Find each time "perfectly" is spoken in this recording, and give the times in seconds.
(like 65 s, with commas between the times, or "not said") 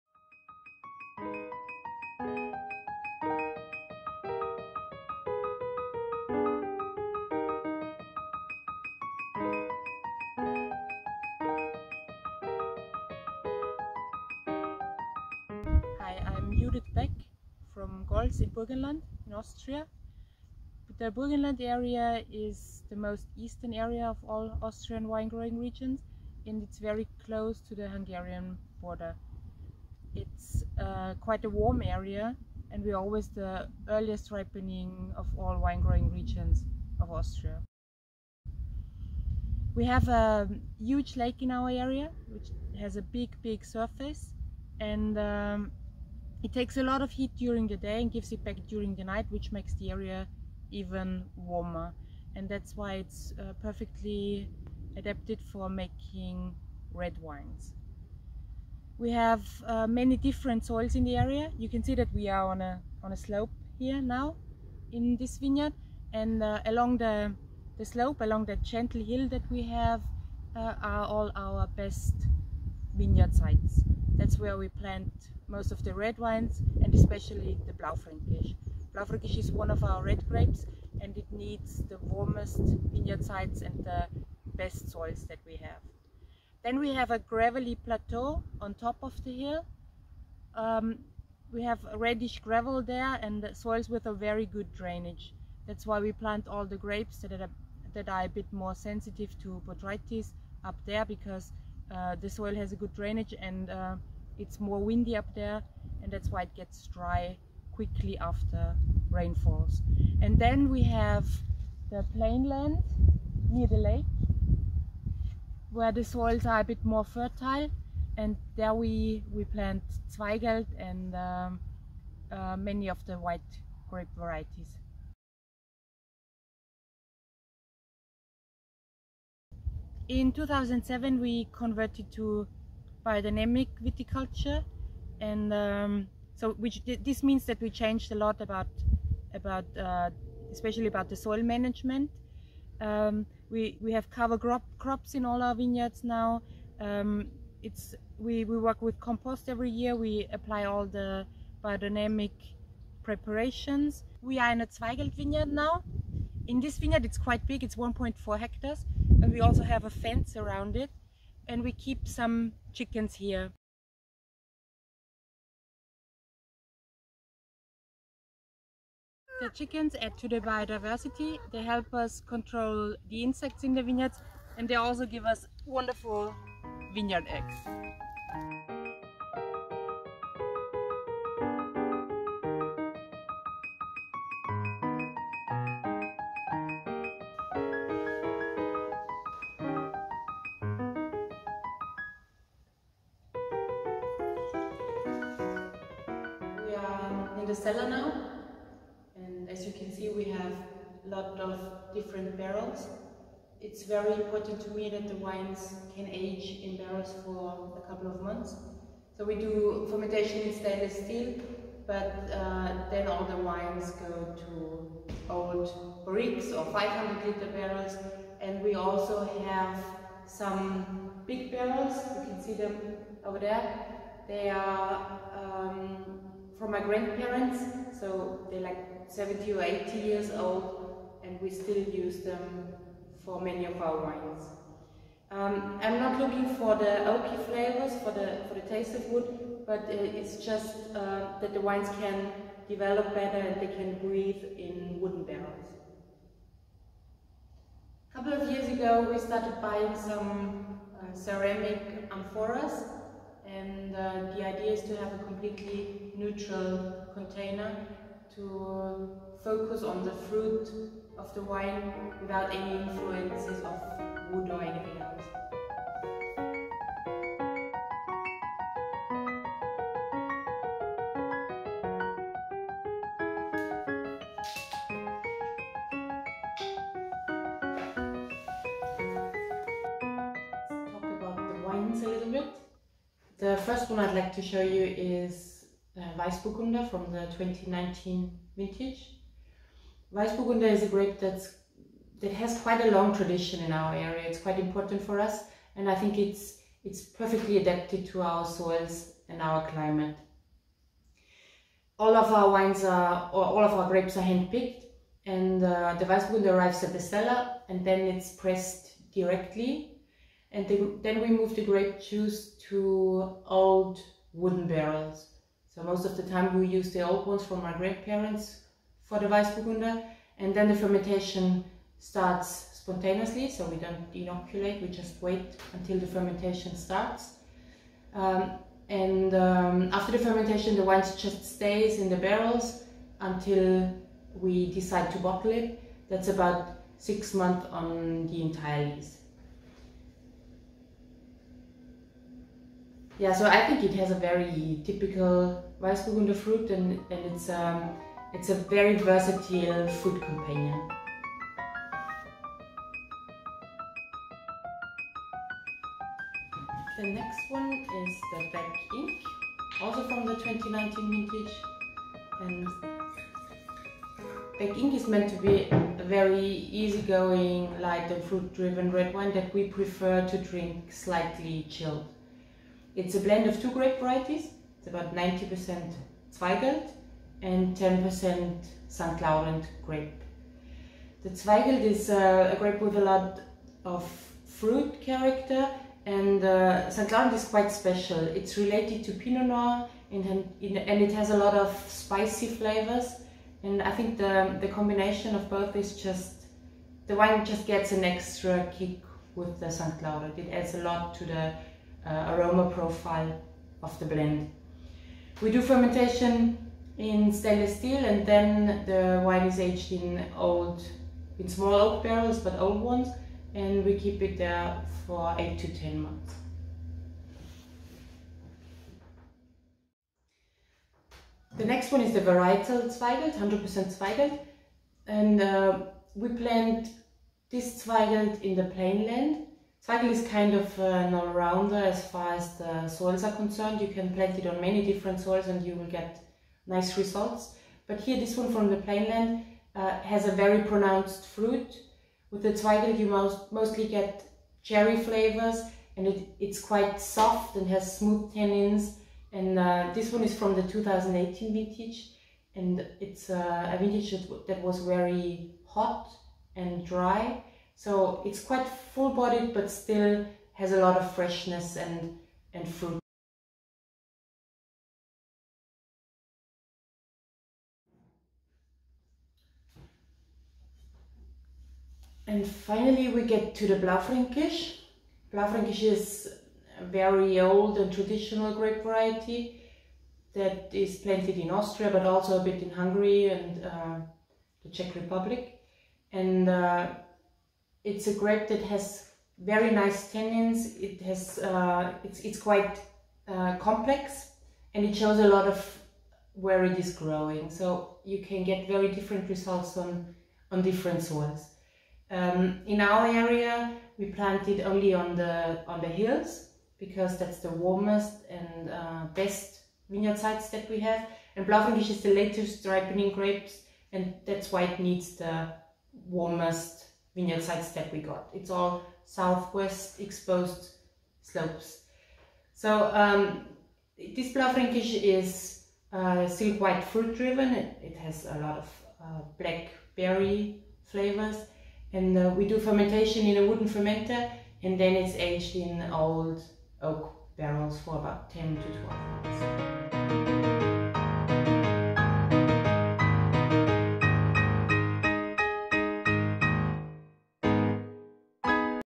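53 s, 297 s.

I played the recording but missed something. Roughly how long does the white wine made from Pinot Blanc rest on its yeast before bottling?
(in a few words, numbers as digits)
six months.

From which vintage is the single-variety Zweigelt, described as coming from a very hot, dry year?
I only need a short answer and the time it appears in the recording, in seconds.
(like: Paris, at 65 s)
2018, at 450 s.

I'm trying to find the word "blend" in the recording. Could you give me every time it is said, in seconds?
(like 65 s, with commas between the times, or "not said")
373 s, 404 s.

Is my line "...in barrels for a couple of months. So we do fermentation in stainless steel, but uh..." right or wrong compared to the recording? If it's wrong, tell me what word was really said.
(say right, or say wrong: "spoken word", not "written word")
right.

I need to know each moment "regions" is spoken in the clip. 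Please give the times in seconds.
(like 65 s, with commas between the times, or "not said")
25 s, 36 s.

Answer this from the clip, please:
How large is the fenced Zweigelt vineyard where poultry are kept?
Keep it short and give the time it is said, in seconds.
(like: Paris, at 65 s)
1.4 hectares, at 157 s.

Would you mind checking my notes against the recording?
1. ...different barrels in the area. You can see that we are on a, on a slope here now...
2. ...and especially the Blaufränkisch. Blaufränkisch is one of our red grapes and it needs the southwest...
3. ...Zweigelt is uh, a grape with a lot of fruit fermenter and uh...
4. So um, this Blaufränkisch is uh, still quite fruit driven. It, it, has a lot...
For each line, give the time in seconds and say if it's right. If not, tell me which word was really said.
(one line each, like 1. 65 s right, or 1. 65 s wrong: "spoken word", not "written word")
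1. 60 s wrong: "soils", not "barrels"
2. 76 s wrong: "warmest", not "southwest"
3. 381 s wrong: "character", not "fermenter"
4. 522 s right.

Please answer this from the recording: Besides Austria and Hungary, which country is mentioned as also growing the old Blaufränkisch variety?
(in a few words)
Czech Republic.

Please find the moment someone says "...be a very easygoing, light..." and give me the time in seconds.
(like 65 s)
365 s.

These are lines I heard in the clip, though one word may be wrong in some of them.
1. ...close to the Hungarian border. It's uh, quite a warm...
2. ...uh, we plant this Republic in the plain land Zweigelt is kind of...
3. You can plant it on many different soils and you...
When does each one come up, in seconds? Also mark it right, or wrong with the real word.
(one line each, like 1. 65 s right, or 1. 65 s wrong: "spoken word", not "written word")
1. 27 s right
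2. 425 s wrong: "Zweigelt", not "Republic"
3. 433 s right.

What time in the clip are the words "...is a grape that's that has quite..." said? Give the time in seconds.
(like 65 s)
290 s.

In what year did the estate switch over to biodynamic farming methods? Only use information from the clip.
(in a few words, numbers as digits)
2007.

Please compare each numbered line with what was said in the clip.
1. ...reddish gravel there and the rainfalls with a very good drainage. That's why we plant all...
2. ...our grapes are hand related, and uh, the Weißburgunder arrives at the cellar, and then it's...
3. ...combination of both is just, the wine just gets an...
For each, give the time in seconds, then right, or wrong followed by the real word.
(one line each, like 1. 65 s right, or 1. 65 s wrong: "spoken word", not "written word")
1. 91 s wrong: "soils", not "rainfalls"
2. 303 s wrong: "picked", not "related"
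3. 394 s right.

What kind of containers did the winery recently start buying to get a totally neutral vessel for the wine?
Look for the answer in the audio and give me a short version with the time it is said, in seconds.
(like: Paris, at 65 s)
ceramic amphoras, at 251 s.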